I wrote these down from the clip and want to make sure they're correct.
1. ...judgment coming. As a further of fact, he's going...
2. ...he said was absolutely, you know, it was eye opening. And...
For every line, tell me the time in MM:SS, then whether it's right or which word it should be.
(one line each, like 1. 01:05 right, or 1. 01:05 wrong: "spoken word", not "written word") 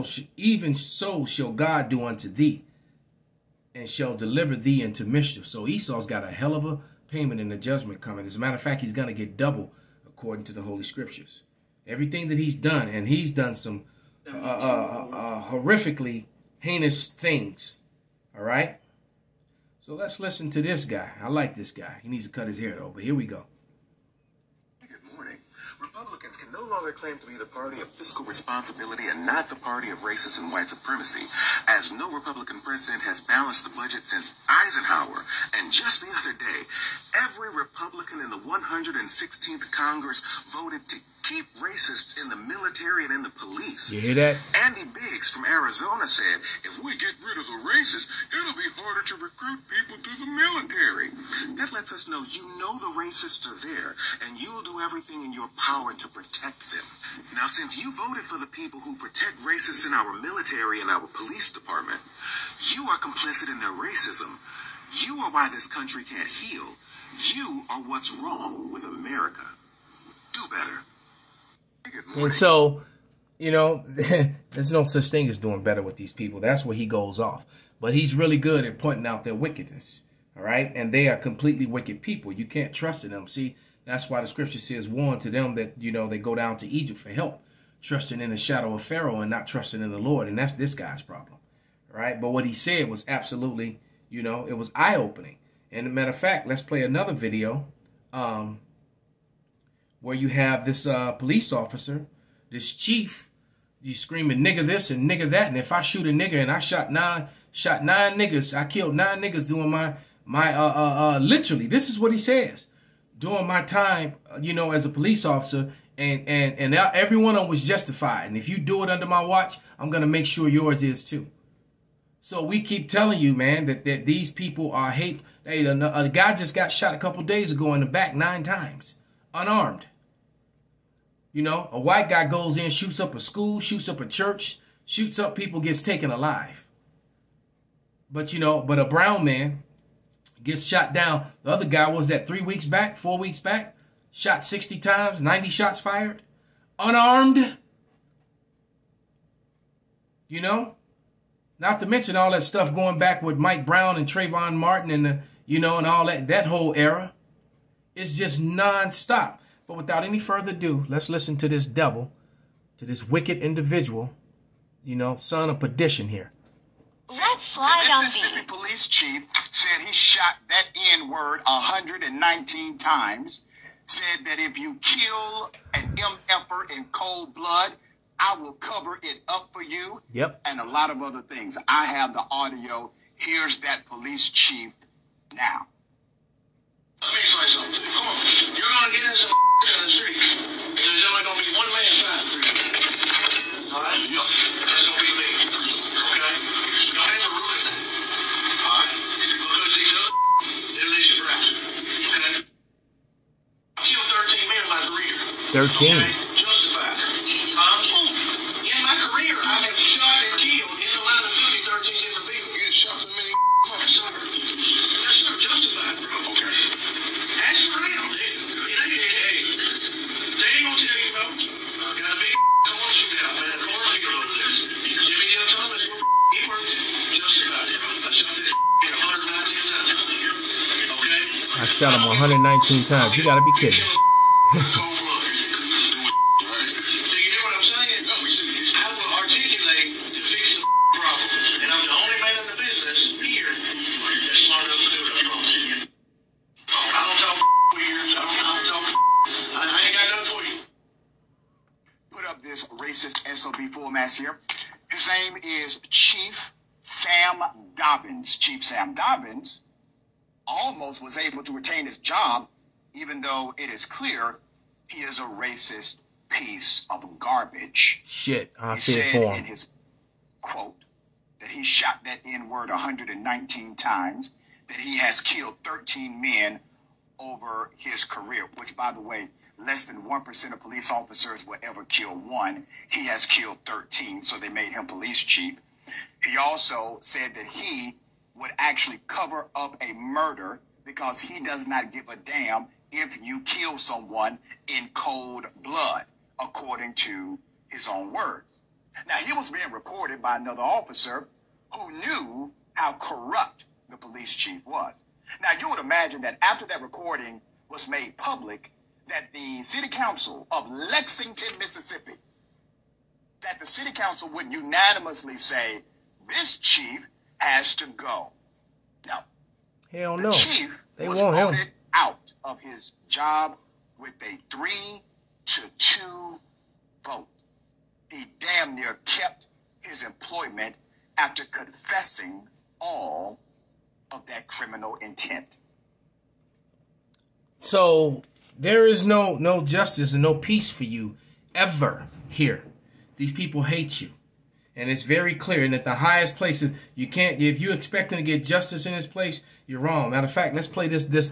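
1. 00:07 wrong: "matter", not "further"
2. 01:32 right.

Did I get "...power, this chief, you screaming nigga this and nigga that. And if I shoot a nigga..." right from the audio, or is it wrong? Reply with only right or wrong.
wrong.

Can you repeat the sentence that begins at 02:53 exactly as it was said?
Said that if you kill an MFer in cold blood, I will cover it up for you.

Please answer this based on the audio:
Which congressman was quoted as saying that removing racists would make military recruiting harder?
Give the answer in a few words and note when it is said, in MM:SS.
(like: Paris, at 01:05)
Andy Biggs, at 00:44.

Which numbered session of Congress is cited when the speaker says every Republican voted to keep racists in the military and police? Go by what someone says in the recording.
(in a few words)
116th Congress.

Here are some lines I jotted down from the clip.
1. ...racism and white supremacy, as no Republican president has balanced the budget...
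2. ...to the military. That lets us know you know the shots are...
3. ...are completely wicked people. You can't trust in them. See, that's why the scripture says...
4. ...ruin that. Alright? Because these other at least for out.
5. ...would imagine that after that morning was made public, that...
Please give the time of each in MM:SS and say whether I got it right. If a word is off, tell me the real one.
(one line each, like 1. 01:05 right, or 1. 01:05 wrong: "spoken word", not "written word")
1. 00:29 right
2. 00:49 wrong: "racists", not "shots"
3. 01:21 right
4. 03:17 right
5. 05:05 wrong: "recording", not "morning".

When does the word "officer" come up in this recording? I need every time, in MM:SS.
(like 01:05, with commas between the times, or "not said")
01:41, 01:55, 04:40, 05:00.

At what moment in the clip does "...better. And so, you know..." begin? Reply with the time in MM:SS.
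01:10.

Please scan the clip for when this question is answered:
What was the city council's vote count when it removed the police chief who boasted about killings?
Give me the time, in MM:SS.
05:24.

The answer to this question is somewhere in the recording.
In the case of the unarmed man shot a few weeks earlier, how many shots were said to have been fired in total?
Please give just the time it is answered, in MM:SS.
02:25.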